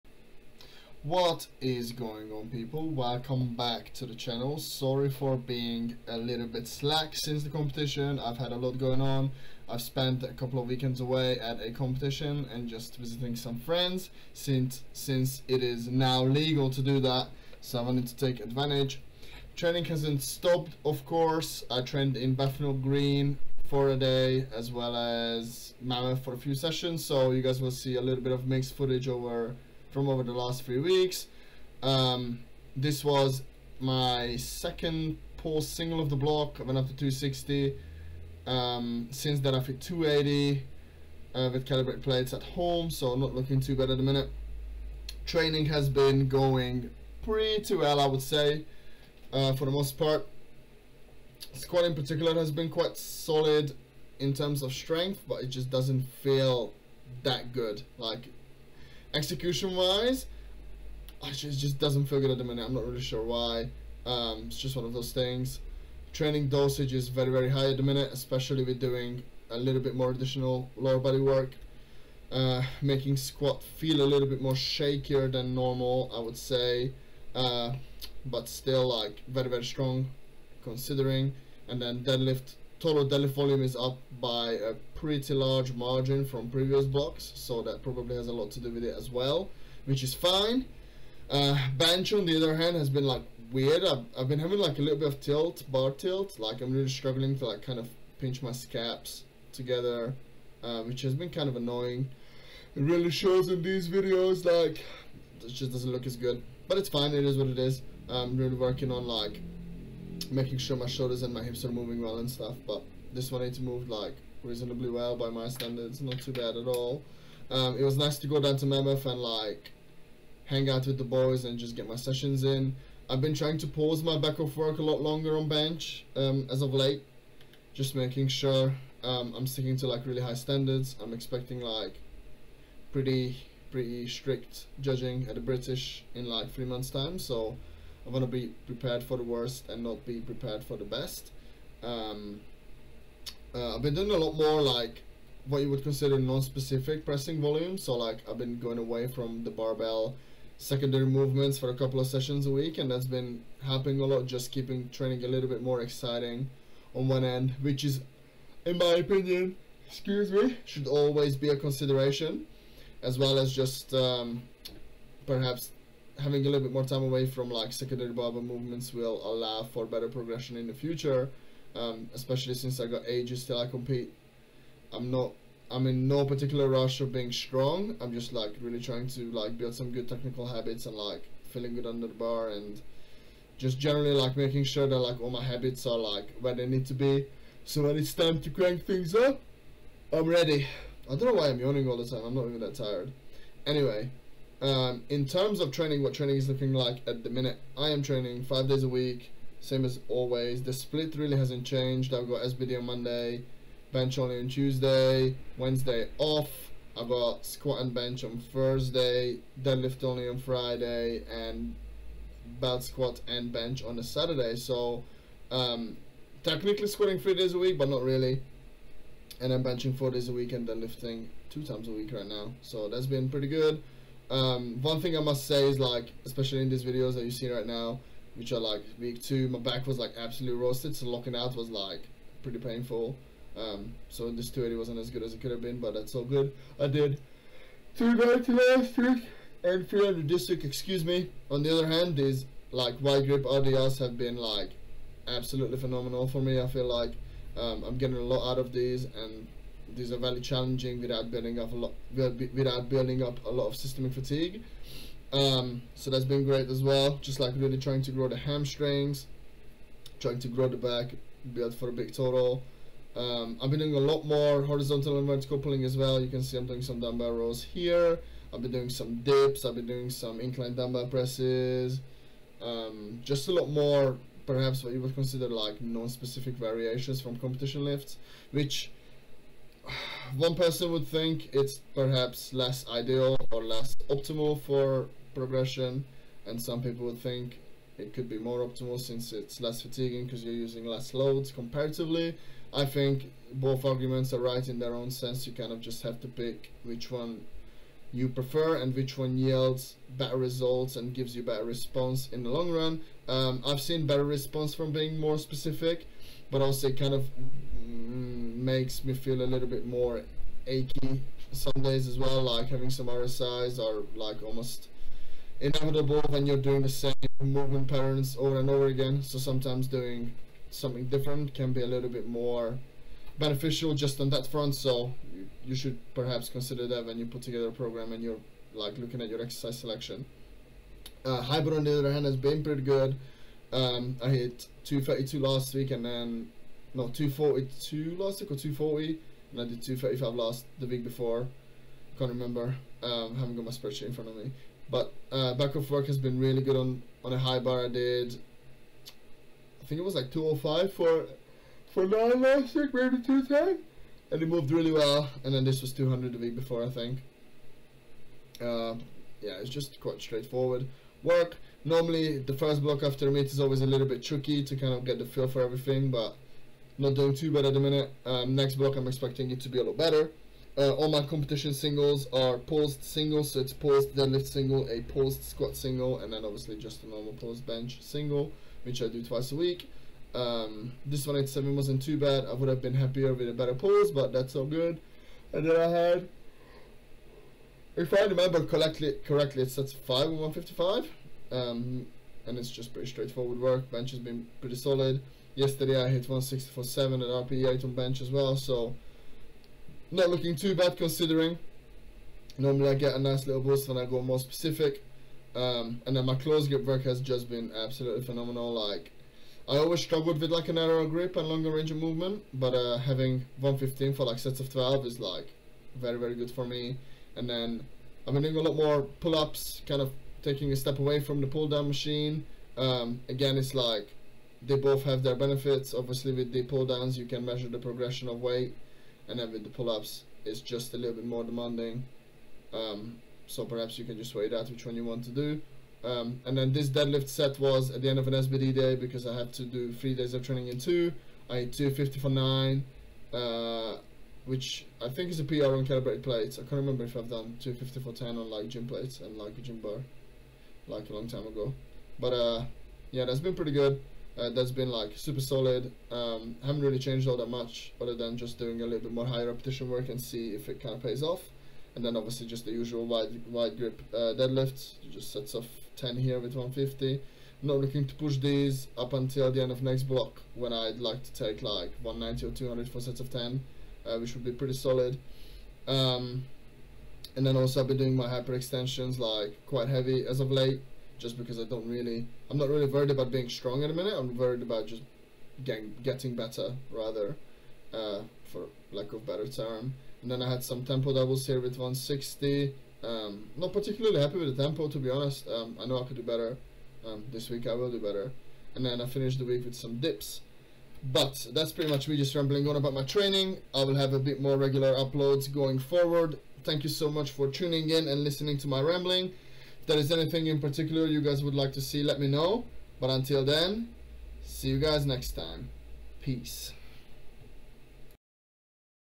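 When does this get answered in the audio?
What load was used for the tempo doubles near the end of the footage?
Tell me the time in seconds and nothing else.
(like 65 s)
491 s.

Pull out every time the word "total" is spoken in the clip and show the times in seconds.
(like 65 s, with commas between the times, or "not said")
82 s, 262 s.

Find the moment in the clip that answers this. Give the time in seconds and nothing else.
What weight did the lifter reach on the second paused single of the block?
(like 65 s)
36 s.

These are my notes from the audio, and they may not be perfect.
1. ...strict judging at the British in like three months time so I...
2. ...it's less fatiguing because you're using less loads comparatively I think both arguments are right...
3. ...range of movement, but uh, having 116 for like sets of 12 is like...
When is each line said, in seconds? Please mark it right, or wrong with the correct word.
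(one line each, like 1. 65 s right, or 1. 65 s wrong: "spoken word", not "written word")
1. 134 s right
2. 289 s right
3. 411 s wrong: "115", not "116".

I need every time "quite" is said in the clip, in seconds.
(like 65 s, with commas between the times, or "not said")
52 s, 360 s, 479 s.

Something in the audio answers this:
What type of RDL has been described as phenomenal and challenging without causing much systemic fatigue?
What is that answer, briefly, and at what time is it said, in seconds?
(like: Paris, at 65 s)
wide grip RDLs, at 243 s.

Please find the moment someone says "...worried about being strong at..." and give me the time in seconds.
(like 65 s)
482 s.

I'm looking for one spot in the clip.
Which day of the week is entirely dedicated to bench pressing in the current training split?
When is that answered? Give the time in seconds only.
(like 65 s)
204 s.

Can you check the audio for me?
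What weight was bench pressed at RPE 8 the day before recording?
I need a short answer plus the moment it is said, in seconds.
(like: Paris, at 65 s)
164.7, at 396 s.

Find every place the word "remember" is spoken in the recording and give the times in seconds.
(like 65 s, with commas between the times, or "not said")
342 s, 388 s, 446 s.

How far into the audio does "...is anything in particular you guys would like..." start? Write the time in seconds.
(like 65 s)
509 s.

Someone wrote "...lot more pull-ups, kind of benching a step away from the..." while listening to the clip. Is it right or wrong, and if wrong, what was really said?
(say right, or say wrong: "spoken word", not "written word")
wrong: "taking", not "benching".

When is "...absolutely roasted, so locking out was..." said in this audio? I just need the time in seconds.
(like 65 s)
230 s.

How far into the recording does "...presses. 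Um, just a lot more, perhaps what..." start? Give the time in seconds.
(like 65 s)
271 s.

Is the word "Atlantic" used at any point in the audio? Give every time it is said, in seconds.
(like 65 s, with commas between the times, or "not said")
not said.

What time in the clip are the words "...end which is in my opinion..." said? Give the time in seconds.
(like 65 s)
157 s.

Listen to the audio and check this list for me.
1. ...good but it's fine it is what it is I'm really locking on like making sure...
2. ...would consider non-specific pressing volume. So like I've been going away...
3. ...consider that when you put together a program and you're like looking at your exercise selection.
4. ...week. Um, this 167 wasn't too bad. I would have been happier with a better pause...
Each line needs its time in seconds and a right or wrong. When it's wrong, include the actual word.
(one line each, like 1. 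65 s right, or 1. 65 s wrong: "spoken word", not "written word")
1. 106 s wrong: "working", not "locking"
2. 145 s right
3. 326 s right
4. 379 s wrong: "187", not "167".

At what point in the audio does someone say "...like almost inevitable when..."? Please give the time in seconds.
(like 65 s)
314 s.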